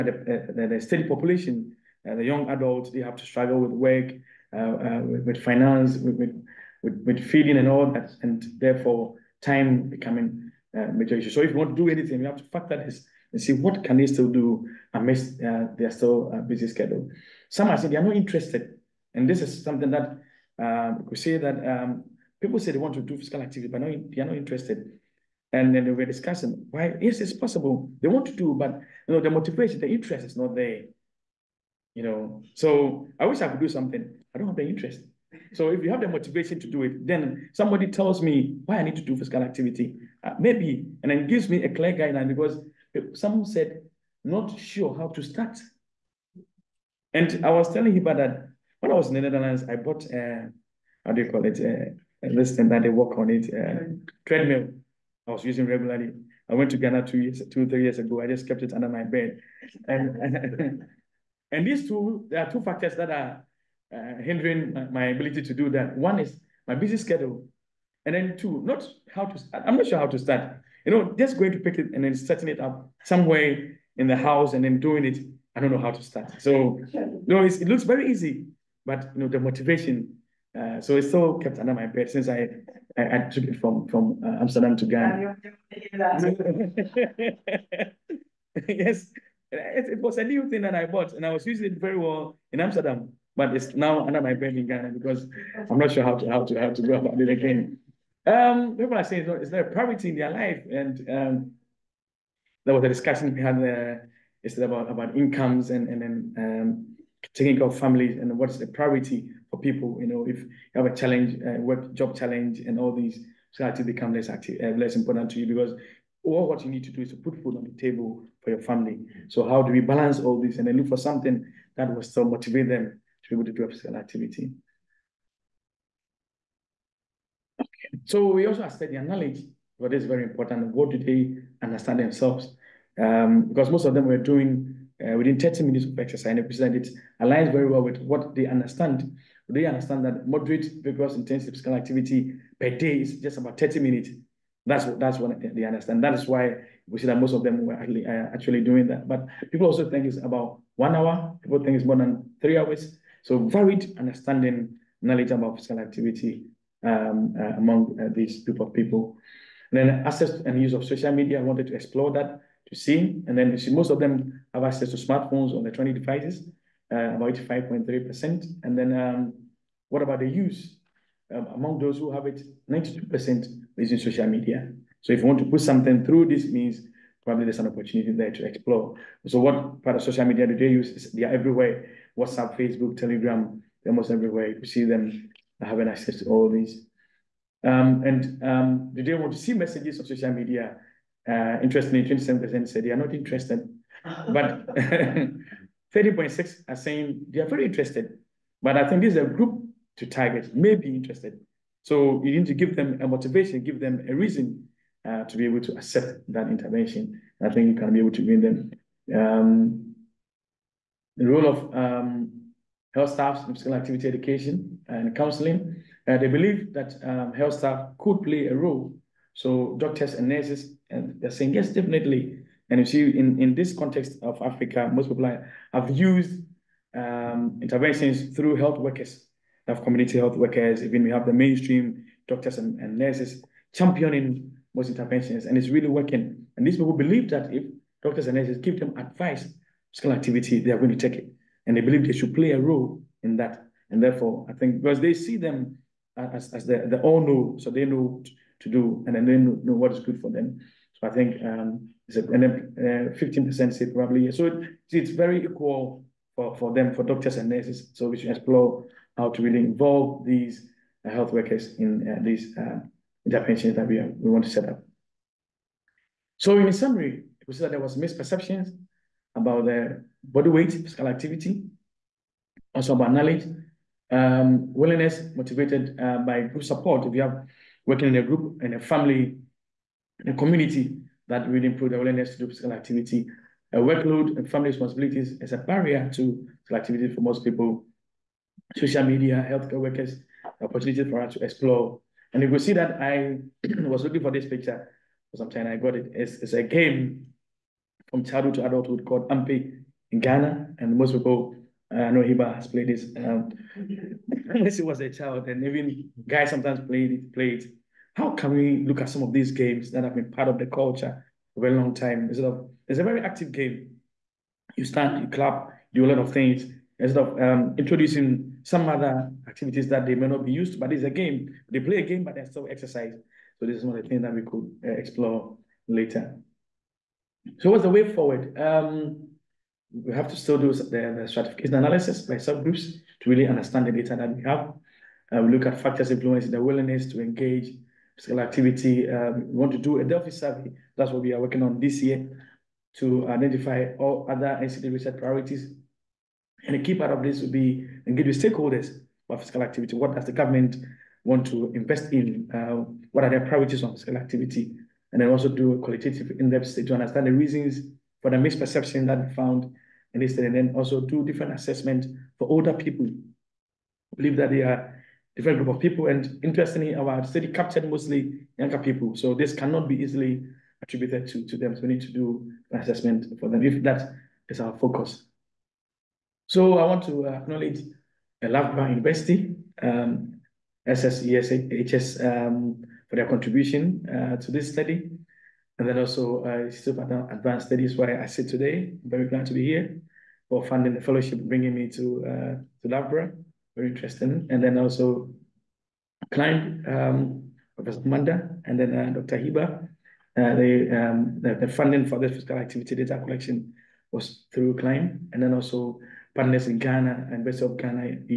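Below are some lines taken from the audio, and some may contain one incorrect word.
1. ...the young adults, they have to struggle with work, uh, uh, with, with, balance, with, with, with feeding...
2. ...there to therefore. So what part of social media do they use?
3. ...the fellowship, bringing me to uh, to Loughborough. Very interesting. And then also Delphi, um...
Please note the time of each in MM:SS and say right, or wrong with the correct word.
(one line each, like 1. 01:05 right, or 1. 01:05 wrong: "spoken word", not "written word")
1. 00:02 wrong: "finance", not "balance"
2. 02:58 wrong: "explore", not "therefore"
3. 06:30 wrong: "CLiMB", not "Delphi".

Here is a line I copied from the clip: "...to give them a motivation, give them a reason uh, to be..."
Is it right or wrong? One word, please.
right.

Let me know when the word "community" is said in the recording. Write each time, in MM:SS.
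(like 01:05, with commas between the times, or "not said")
03:49, 04:40.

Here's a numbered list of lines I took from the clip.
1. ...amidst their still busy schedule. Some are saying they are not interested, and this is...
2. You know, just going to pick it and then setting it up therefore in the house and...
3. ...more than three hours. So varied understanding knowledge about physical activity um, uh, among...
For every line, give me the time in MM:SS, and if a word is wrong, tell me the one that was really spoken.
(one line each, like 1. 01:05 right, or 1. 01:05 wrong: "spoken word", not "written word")
1. 00:14 right
2. 01:10 wrong: "somewhere", not "therefore"
3. 02:31 right.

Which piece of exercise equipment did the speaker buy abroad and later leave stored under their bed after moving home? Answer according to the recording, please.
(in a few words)
treadmill.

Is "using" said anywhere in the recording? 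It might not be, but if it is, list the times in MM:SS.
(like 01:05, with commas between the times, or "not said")
00:55, 01:31.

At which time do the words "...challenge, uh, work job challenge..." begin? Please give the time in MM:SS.
01:50.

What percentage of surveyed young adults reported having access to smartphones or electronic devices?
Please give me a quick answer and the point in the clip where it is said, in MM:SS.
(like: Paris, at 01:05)
85.3%, at 02:47.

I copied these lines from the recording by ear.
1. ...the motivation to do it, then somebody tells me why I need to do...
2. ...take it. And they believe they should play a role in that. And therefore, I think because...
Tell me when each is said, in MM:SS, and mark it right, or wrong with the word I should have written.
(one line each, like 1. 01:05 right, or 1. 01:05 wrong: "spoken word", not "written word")
1. 00:36 right
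2. 04:01 right.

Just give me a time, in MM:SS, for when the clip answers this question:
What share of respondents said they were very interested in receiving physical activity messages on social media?
03:15.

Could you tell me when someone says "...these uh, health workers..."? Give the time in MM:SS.
04:20.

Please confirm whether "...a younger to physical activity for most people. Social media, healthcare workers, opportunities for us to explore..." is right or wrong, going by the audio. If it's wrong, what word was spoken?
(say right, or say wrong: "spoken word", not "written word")
wrong: "barrier", not "younger".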